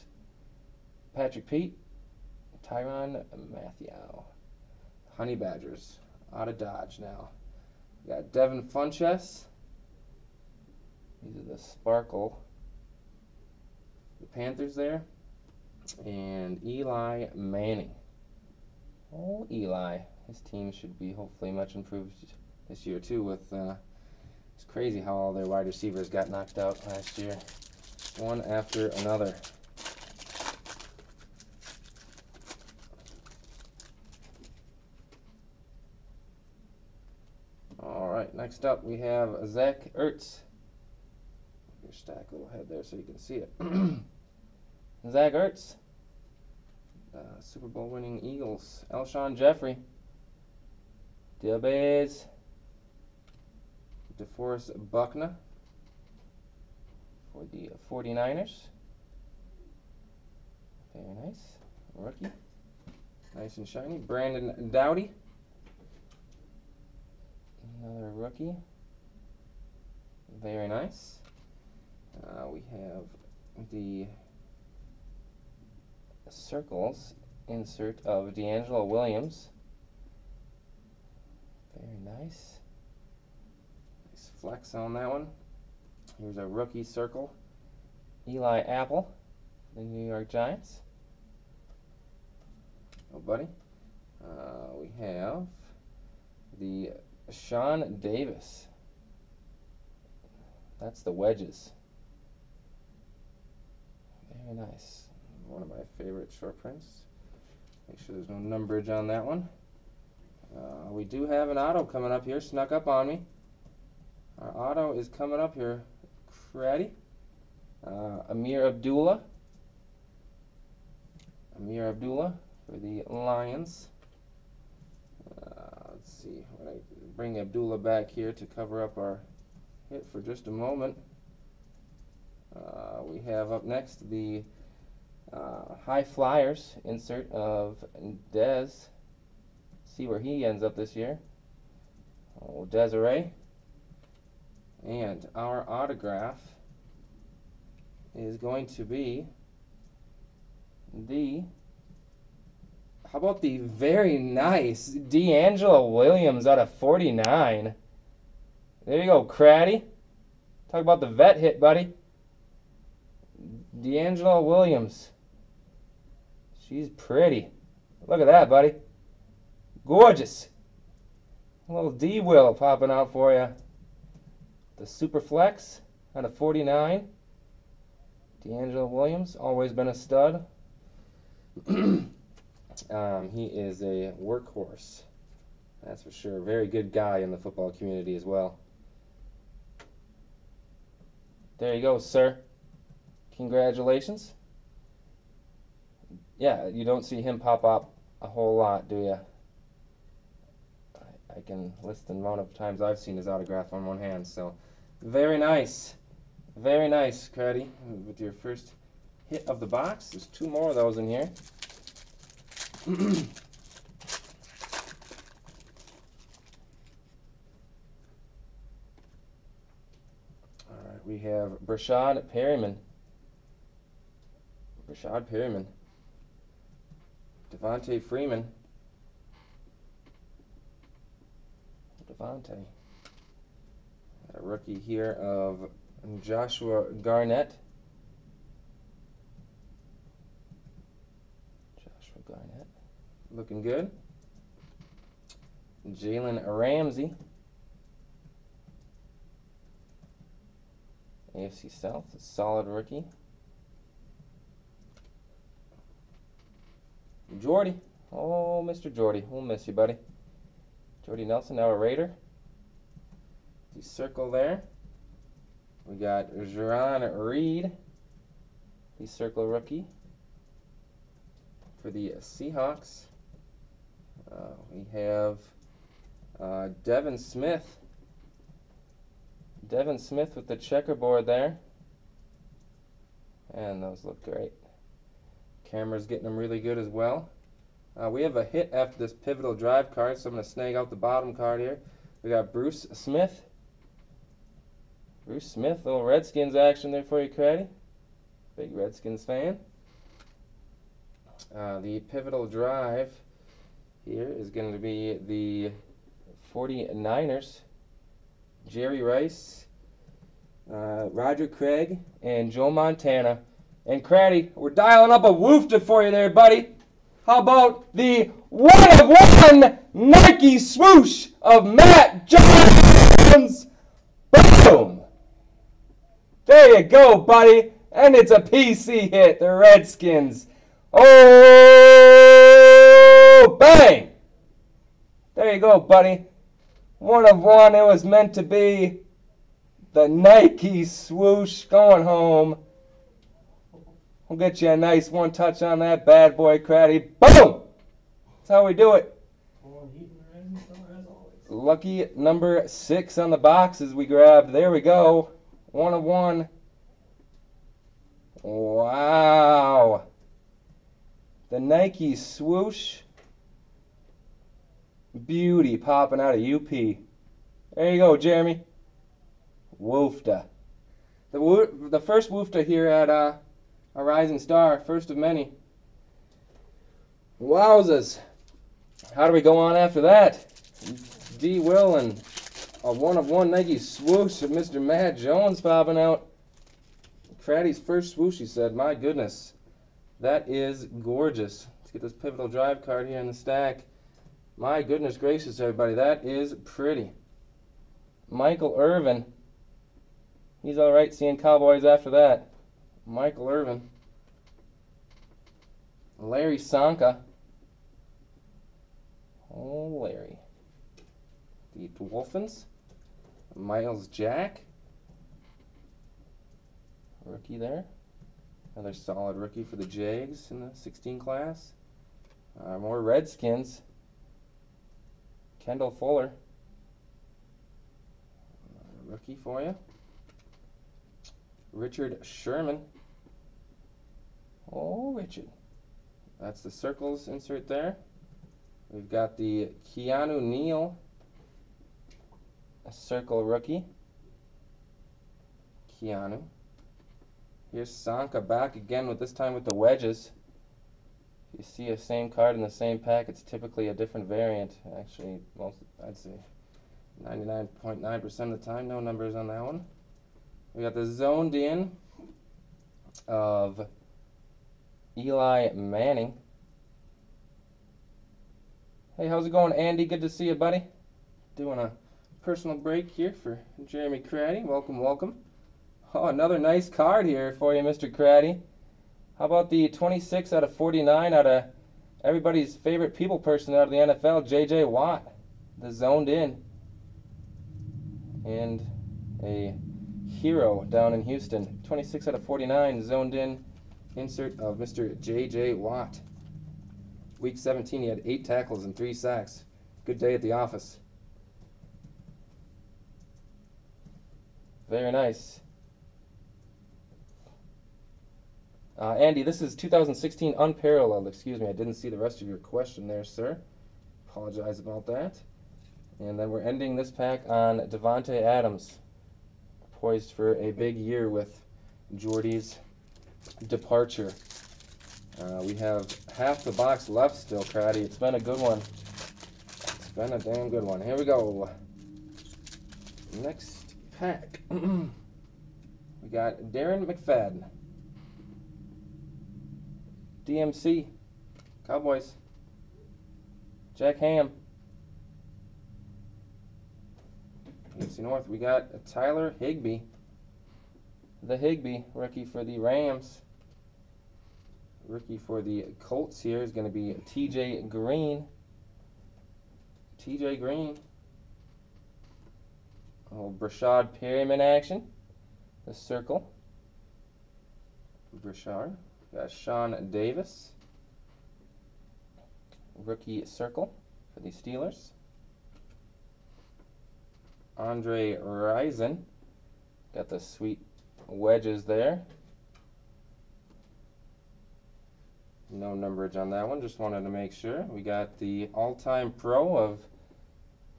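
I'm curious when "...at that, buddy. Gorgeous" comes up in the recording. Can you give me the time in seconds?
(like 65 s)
168 s.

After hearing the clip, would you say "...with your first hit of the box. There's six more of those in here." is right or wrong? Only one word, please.
wrong.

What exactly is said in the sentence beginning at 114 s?
Our auto is coming up here.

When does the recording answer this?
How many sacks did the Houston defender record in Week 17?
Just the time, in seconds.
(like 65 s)
498 s.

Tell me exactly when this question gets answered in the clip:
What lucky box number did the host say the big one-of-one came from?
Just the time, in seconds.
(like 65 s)
351 s.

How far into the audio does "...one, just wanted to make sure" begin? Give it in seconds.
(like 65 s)
586 s.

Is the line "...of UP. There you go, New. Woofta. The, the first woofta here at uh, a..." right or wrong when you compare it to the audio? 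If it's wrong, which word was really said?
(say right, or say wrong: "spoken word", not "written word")
wrong: "Jeremy", not "New".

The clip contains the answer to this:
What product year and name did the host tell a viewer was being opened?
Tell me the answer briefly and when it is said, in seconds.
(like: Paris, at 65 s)
2016 Unparalleled, at 509 s.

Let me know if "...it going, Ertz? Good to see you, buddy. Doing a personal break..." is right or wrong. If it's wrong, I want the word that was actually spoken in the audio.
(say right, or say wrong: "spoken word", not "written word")
wrong: "Andy", not "Ertz".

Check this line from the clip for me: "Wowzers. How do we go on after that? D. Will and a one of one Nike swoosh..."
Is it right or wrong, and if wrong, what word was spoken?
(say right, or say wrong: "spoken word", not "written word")
right.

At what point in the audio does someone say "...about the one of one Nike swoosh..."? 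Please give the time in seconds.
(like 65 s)
317 s.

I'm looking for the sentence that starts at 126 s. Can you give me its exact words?
When I bring Abdullah back here to cover up our hit for just a moment.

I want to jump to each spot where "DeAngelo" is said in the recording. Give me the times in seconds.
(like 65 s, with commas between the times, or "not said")
78 s, 154 s, 163 s.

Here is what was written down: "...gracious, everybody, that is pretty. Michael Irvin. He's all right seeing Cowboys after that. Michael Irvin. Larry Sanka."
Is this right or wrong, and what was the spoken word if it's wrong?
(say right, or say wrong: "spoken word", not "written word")
right.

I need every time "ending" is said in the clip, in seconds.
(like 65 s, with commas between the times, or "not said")
516 s.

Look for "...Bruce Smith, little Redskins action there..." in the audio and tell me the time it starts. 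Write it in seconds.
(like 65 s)
295 s.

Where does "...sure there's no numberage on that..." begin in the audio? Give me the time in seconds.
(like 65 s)
108 s.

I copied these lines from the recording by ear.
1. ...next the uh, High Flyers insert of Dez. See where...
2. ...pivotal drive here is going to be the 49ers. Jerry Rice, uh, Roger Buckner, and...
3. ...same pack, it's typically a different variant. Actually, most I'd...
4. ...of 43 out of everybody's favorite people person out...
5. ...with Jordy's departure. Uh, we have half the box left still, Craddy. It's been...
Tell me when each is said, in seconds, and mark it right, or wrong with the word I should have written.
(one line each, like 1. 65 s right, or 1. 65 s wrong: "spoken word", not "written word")
1. 133 s right
2. 301 s wrong: "Craig", not "Buckner"
3. 452 s right
4. 480 s wrong: "49", not "43"
5. 521 s right.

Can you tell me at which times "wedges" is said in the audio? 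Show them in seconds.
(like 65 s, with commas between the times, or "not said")
101 s, 449 s, 581 s.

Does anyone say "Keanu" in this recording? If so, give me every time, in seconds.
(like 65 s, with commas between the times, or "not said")
439 s, 445 s.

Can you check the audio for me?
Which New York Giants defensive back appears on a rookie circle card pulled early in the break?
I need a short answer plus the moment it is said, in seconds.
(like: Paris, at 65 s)
Eli Apple, at 88 s.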